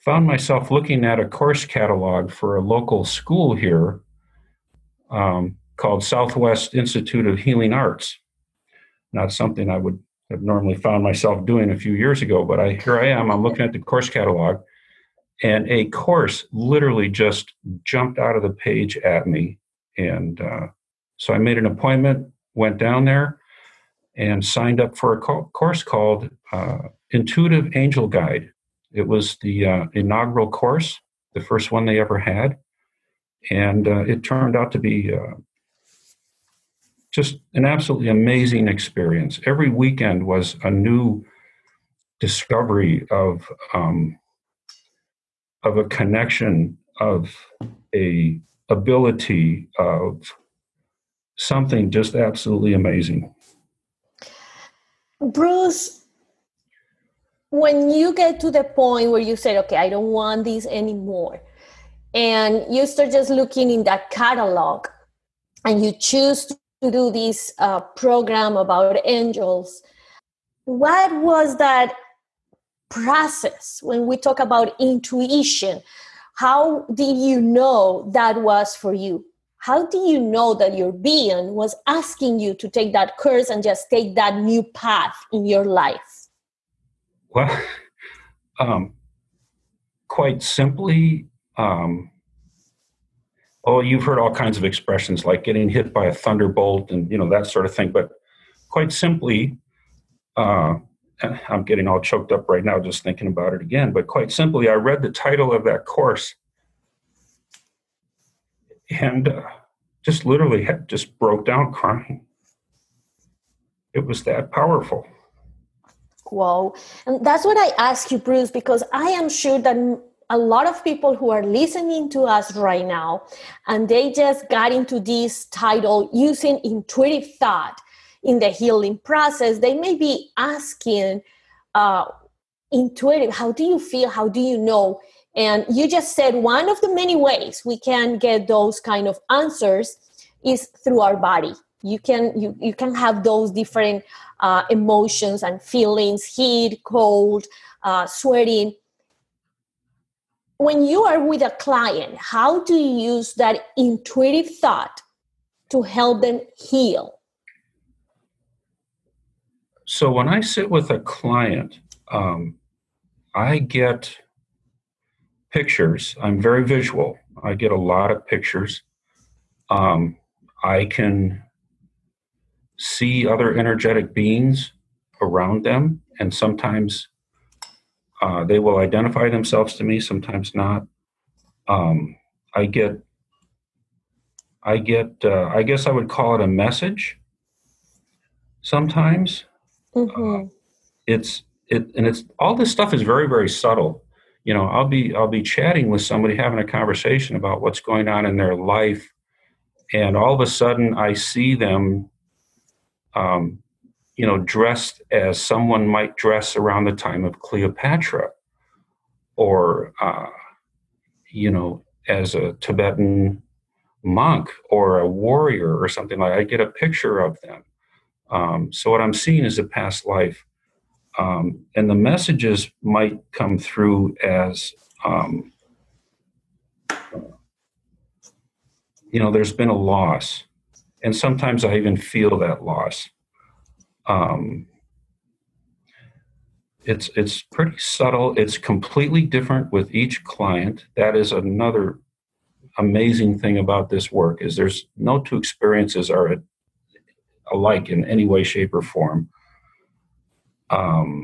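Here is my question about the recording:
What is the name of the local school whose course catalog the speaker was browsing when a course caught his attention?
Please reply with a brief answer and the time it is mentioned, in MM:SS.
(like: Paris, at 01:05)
Southwest Institute of Healing Arts, at 00:06.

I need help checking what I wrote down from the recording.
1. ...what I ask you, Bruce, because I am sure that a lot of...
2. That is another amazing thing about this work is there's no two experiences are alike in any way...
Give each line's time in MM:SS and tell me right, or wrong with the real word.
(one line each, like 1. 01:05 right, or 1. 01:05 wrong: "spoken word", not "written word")
1. 01:57 right
2. 04:00 right.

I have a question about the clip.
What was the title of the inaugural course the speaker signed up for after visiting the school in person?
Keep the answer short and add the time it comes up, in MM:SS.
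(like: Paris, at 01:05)
Intuitive Angel Guide, at 00:27.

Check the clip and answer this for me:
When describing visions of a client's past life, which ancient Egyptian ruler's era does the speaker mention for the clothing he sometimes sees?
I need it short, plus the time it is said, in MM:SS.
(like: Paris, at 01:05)
Cleopatra, at 03:27.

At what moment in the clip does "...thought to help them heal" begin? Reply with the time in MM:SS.
02:34.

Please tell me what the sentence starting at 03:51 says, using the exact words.
And sometimes I even feel that loss um, it's it's pretty subtle.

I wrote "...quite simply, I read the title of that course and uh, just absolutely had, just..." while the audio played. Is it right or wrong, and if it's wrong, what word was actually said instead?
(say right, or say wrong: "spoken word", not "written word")
wrong: "literally", not "absolutely".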